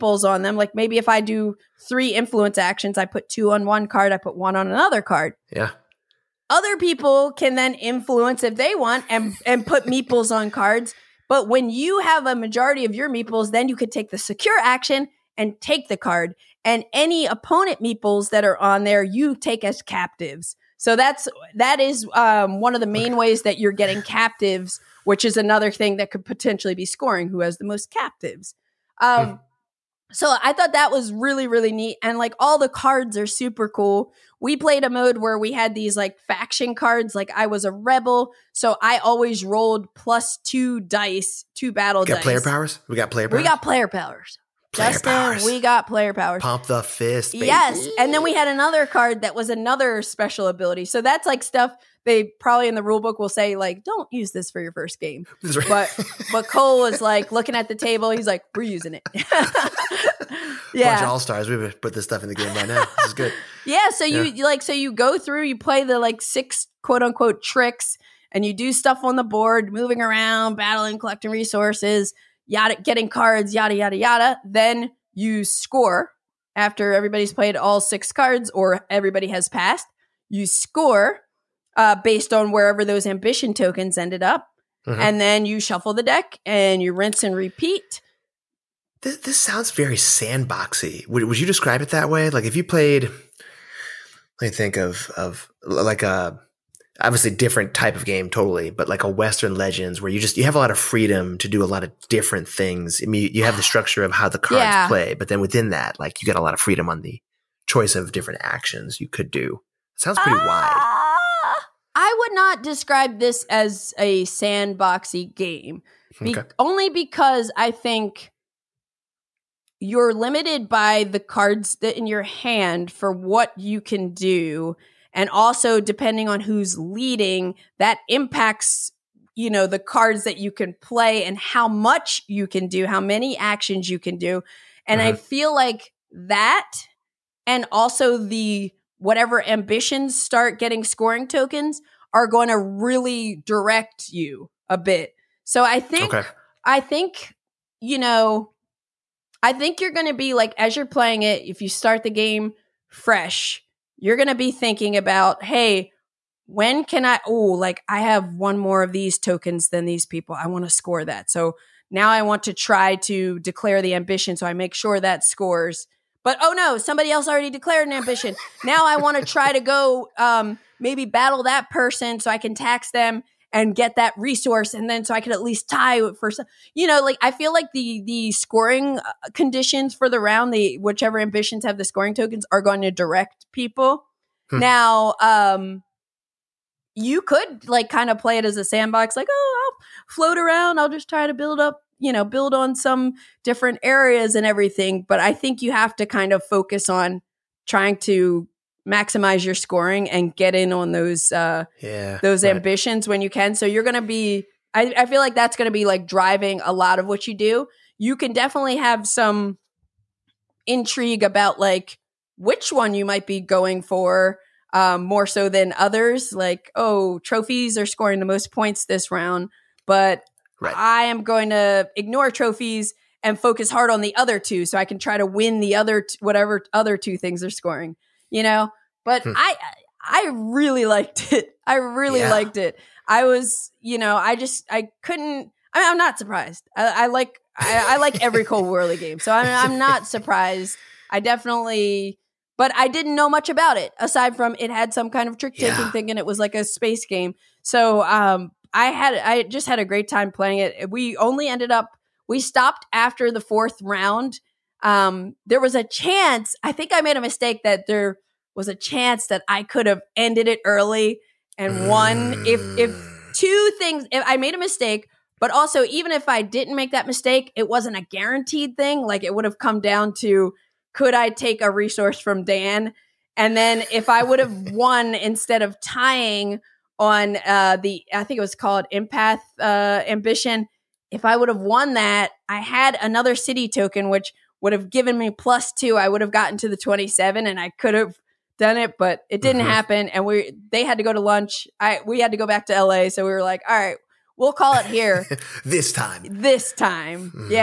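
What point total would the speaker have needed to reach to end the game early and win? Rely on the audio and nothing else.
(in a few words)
27.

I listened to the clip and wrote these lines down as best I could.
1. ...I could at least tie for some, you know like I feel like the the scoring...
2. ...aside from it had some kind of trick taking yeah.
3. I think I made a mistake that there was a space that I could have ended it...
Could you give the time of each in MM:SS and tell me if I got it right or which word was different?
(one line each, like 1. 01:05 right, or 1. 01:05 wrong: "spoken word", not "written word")
1. 02:55 right
2. 04:03 right
3. 04:16 wrong: "chance", not "space".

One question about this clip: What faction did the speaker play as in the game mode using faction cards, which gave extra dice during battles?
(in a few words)
Rebel.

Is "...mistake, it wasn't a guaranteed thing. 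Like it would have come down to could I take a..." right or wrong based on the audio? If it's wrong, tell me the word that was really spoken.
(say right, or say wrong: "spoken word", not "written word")
right.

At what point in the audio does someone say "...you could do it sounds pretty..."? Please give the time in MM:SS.
01:49.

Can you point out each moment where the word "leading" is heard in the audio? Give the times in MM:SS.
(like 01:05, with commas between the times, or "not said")
02:06.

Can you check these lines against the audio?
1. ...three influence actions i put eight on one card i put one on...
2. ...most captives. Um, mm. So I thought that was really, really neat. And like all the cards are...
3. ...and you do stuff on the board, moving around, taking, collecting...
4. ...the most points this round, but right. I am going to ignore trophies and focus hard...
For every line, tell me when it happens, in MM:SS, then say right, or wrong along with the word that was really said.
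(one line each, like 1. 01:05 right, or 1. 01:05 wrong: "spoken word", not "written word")
1. 00:01 wrong: "two", not "eight"
2. 00:27 right
3. 01:08 wrong: "battling", not "taking"
4. 03:38 right.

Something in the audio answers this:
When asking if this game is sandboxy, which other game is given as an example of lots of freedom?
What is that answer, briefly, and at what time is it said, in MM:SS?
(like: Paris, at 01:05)
Western Legends, at 01:39.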